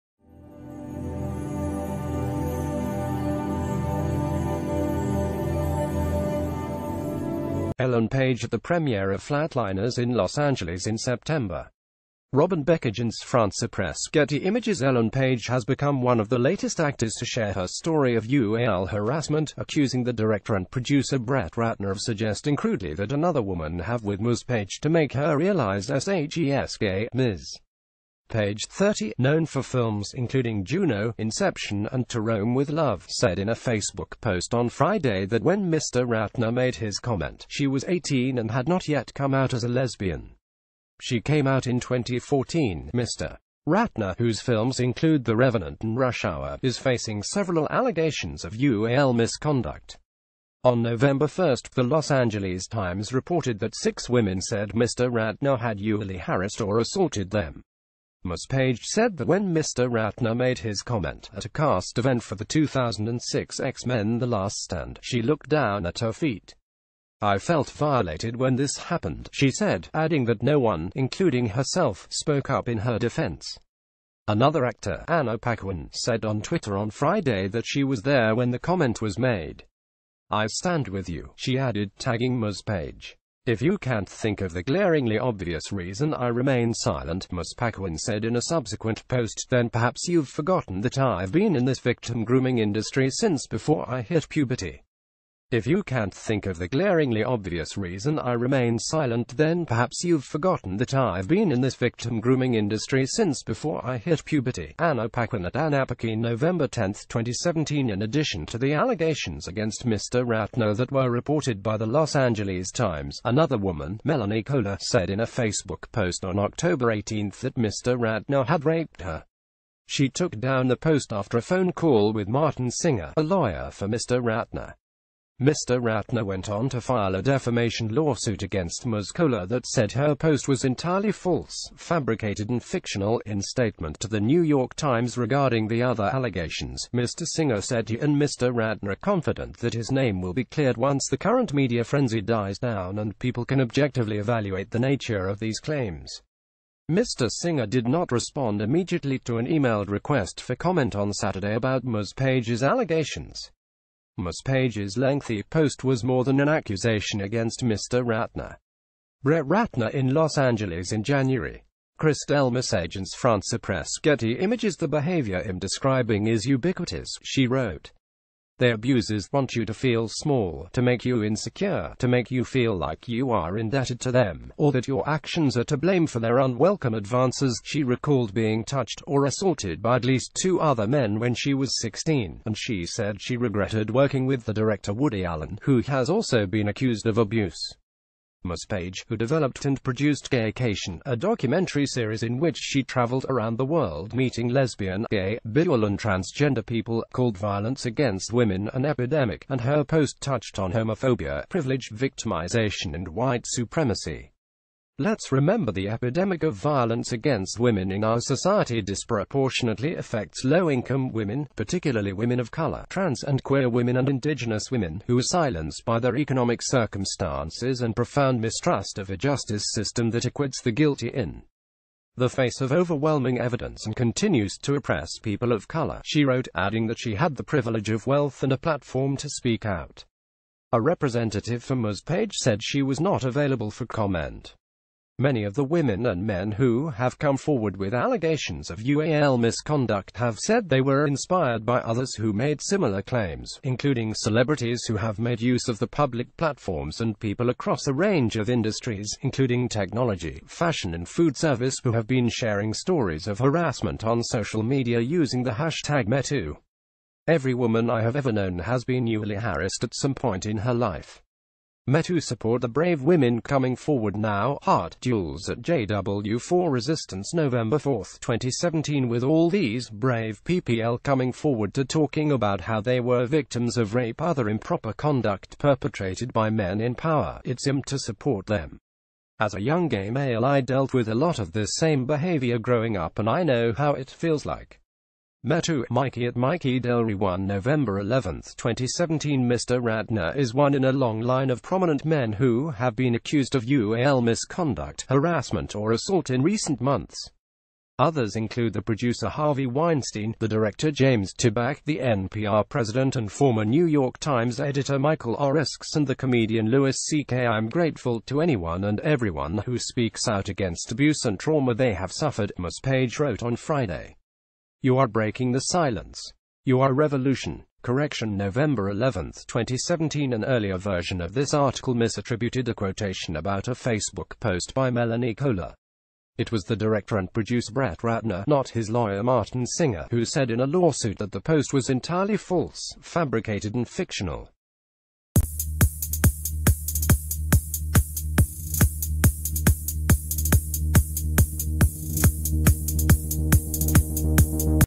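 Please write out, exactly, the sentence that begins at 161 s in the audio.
Chris Delmas agents France Press Getty images the behavior I'm describing is ubiquitous, she wrote.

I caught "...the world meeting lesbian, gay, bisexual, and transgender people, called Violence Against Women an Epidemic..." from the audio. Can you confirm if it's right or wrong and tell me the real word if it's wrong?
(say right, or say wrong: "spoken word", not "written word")
right.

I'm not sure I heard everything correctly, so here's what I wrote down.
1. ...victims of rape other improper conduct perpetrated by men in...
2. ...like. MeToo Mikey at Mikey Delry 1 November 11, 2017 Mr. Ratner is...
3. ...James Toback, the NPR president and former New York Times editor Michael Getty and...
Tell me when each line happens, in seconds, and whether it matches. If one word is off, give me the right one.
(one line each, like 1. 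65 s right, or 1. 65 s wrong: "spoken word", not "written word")
1. 273 s right
2. 284 s right
3. 300 s wrong: "Oreskes", not "Getty".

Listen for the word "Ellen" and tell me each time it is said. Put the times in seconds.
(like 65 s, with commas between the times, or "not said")
7 s, 14 s.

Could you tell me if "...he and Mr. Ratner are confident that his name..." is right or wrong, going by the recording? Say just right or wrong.
right.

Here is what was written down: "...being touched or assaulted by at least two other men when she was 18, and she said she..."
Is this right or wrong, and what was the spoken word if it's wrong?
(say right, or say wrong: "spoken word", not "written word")
wrong: "16", not "18".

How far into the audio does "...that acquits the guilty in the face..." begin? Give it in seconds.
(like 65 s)
220 s.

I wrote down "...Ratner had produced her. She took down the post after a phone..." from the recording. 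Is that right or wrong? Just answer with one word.
wrong.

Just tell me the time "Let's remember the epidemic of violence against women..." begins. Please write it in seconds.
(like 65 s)
205 s.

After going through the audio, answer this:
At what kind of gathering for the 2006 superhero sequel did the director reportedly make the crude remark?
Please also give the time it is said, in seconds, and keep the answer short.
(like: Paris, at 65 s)
cast event, at 61 s.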